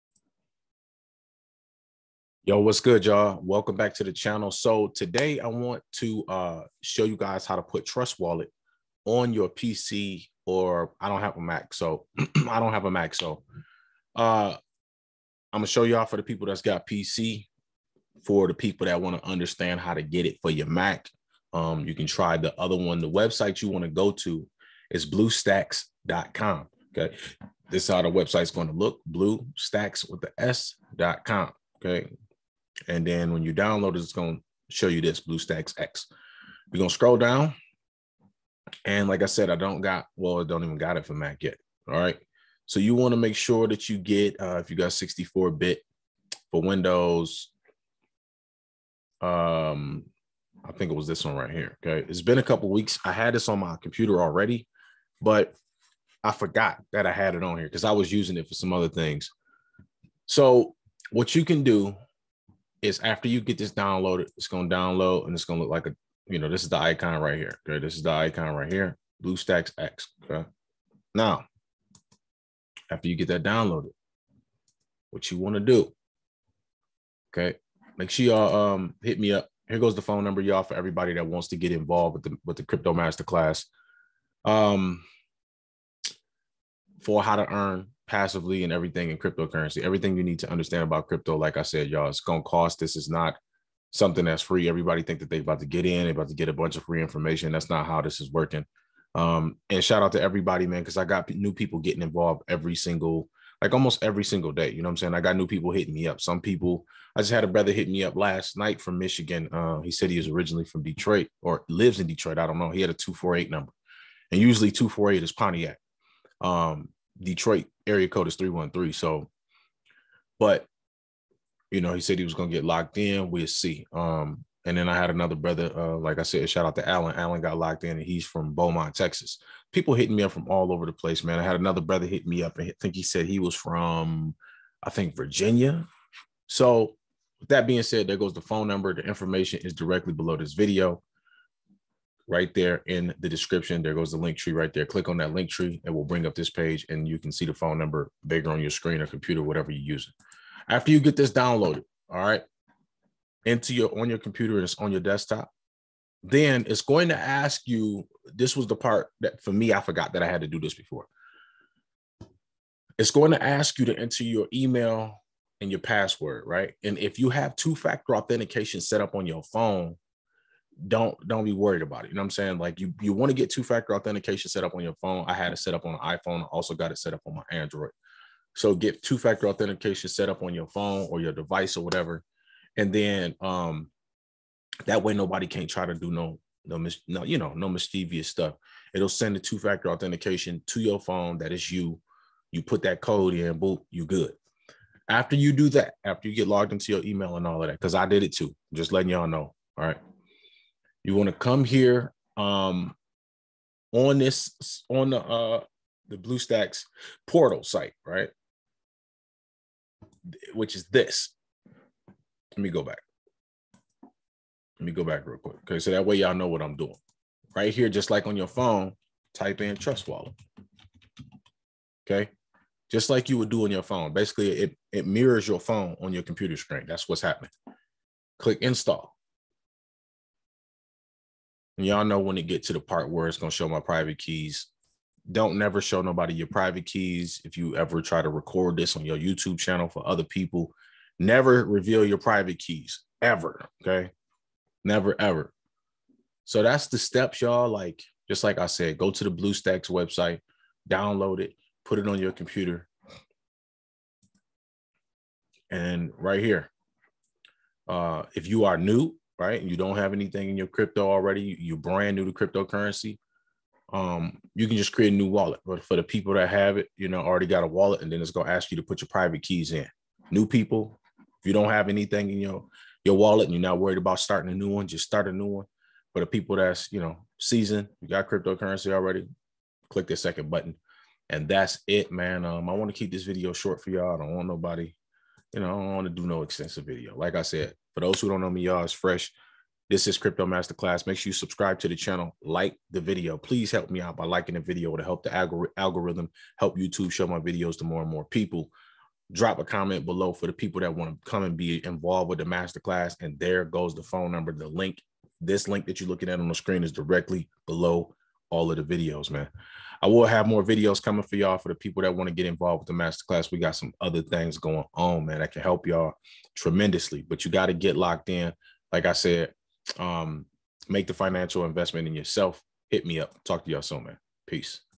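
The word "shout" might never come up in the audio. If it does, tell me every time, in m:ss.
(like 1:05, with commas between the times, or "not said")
1:39, 2:06.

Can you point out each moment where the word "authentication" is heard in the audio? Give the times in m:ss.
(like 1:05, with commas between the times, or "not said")
2:48, 2:53, 2:59, 3:09.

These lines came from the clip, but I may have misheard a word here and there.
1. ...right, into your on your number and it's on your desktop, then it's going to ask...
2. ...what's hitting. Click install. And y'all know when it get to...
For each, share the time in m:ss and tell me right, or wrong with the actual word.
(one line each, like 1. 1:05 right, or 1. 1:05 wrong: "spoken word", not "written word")
1. 2:32 wrong: "computer", not "number"
2. 3:47 wrong: "happening", not "hitting".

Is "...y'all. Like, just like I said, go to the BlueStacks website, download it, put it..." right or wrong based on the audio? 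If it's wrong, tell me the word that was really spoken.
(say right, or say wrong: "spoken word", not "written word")
right.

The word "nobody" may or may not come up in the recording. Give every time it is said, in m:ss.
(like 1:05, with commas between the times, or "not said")
3:05, 3:56, 4:44.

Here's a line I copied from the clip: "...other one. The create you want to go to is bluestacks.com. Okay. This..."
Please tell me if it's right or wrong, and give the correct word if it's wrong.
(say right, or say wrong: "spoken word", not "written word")
wrong: "website", not "create".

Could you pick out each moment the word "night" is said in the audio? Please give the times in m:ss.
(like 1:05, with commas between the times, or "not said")
1:48.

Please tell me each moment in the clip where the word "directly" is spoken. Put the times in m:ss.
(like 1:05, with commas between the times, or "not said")
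2:19, 5:06.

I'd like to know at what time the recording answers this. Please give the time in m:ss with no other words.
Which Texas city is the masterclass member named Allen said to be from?
2:08.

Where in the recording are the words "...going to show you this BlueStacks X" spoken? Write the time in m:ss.
0:34.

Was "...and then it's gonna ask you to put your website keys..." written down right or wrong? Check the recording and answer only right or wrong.
wrong.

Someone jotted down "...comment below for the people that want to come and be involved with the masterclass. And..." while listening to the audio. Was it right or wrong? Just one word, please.
right.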